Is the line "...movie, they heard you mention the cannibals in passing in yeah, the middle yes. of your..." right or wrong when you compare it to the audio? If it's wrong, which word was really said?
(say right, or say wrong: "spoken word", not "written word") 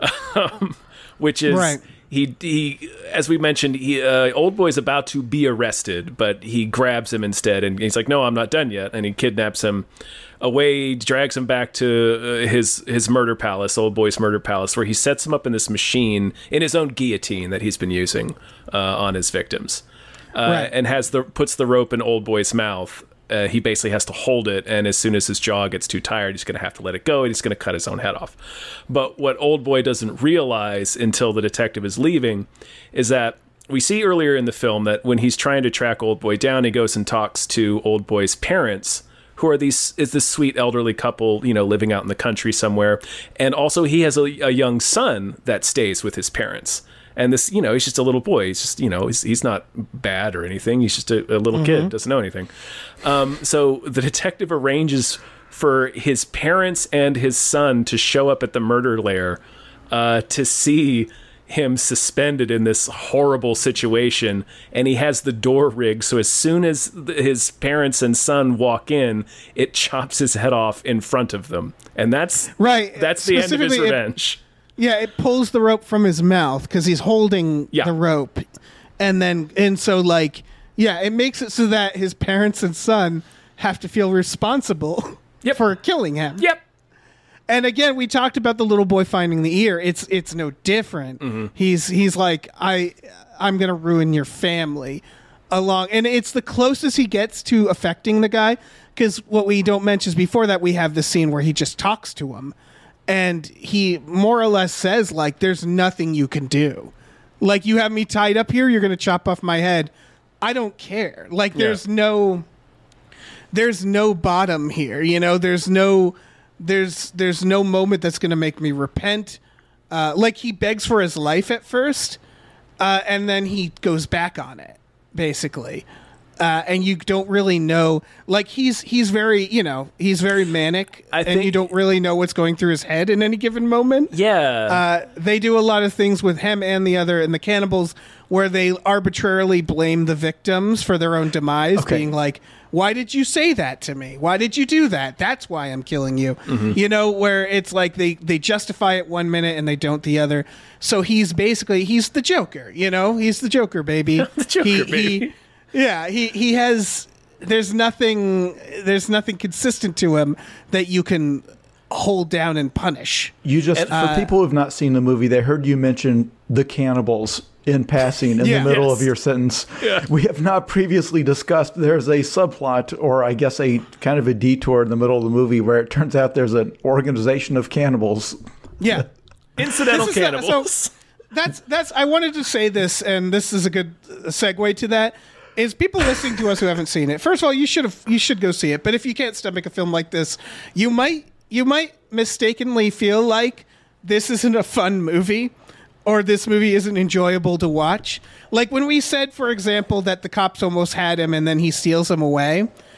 right.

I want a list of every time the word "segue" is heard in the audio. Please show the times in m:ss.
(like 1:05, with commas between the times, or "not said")
3:04.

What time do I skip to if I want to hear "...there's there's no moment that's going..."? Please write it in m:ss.
1:56.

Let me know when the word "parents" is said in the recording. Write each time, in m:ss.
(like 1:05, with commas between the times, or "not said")
0:38, 0:46, 0:56, 1:07, 1:22.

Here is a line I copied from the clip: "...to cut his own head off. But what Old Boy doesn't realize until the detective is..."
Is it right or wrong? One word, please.
right.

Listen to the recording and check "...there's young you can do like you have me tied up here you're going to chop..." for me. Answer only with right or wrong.
wrong.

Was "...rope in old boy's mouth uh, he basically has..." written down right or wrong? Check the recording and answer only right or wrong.
right.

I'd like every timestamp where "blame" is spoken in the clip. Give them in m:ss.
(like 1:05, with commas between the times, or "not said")
2:19.